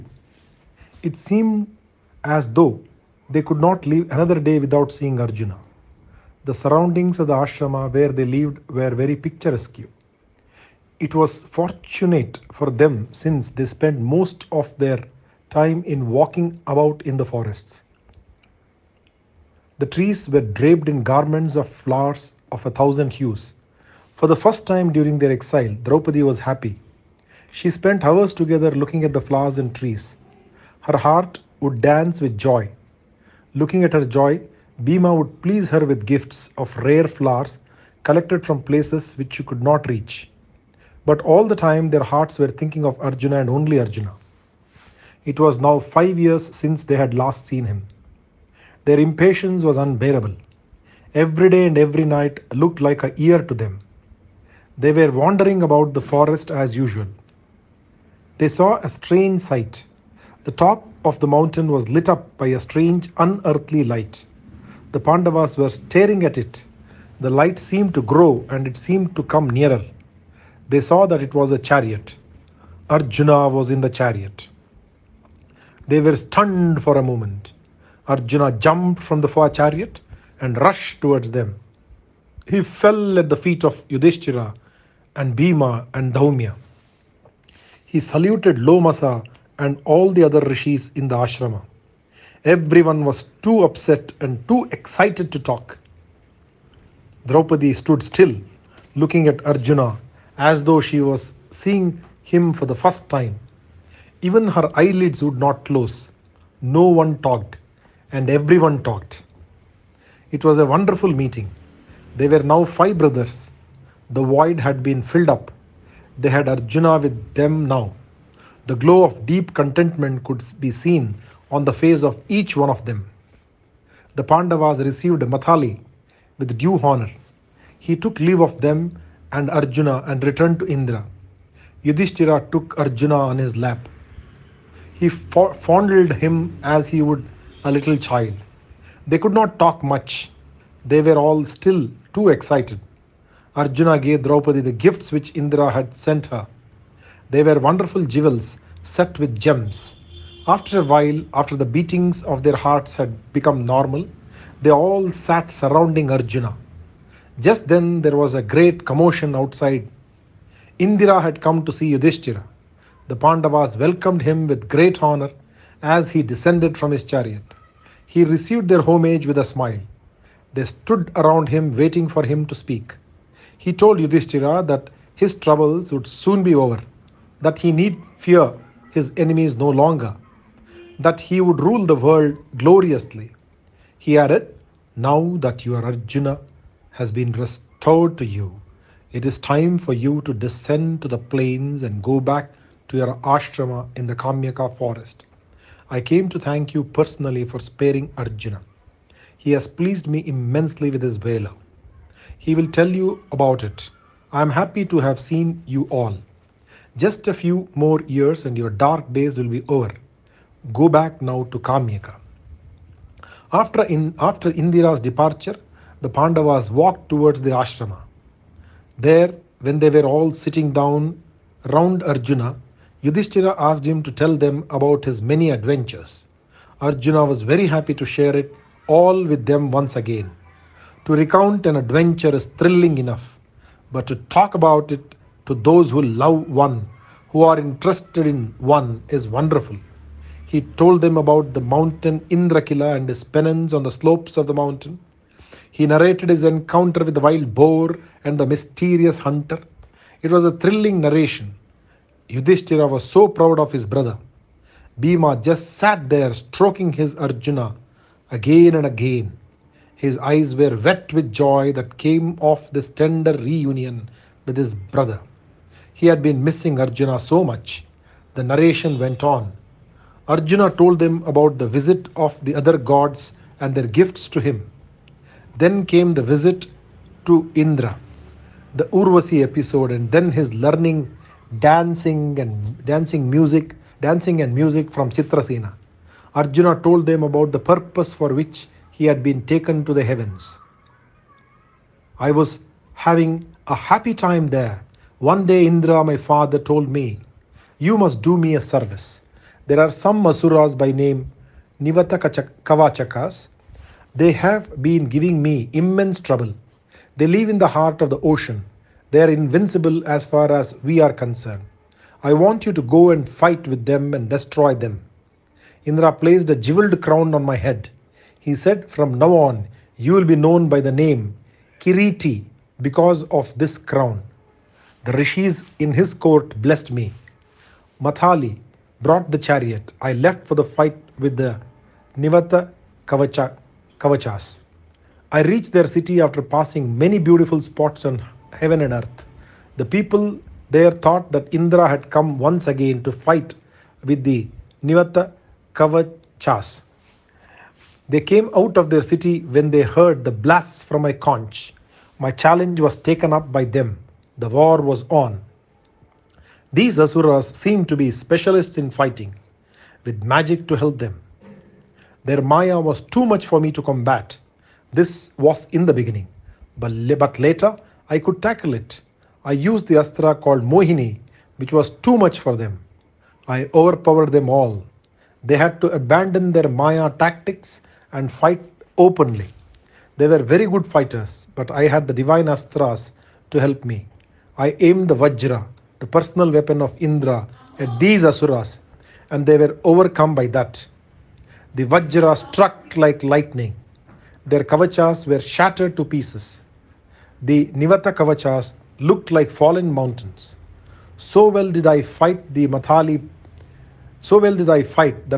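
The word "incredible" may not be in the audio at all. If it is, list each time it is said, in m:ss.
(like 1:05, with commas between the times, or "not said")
not said.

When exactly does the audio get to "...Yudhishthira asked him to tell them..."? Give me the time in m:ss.
3:43.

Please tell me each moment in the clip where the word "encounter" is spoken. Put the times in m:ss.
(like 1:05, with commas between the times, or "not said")
4:06.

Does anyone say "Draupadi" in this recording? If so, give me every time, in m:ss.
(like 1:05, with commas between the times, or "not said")
0:25, 1:37, 2:24.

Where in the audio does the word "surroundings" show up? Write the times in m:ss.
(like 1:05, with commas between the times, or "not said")
0:06, 2:35.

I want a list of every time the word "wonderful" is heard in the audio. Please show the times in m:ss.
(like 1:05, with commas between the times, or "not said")
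1:50, 2:27, 3:59.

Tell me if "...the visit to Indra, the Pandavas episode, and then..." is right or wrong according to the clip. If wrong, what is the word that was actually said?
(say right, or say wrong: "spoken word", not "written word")
wrong: "Urvasi", not "Pandavas".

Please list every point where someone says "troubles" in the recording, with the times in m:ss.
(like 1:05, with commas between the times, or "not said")
2:55, 5:06.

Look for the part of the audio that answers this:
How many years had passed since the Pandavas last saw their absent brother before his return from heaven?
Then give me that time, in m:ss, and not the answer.
0:45.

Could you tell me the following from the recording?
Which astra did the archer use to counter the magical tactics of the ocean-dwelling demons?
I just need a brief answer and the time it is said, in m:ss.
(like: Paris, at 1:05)
Mohini, at 6:10.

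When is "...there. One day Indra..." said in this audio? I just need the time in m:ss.
4:54.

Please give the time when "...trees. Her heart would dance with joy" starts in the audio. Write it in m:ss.
0:29.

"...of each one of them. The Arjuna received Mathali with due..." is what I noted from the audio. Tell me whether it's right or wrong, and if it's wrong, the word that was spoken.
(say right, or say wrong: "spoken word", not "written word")
wrong: "Pandavas", not "Arjuna".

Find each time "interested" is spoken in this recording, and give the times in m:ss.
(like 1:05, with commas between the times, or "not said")
3:57.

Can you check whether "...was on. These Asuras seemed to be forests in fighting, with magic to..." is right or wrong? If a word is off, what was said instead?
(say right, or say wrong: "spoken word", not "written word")
wrong: "specialists", not "forests".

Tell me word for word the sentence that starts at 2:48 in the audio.
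He received their homage with a smile.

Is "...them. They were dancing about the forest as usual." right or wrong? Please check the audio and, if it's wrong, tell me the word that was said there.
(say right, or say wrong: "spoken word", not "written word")
wrong: "wandering", not "dancing".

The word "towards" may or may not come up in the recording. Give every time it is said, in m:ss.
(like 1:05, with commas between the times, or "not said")
1:20, 3:37.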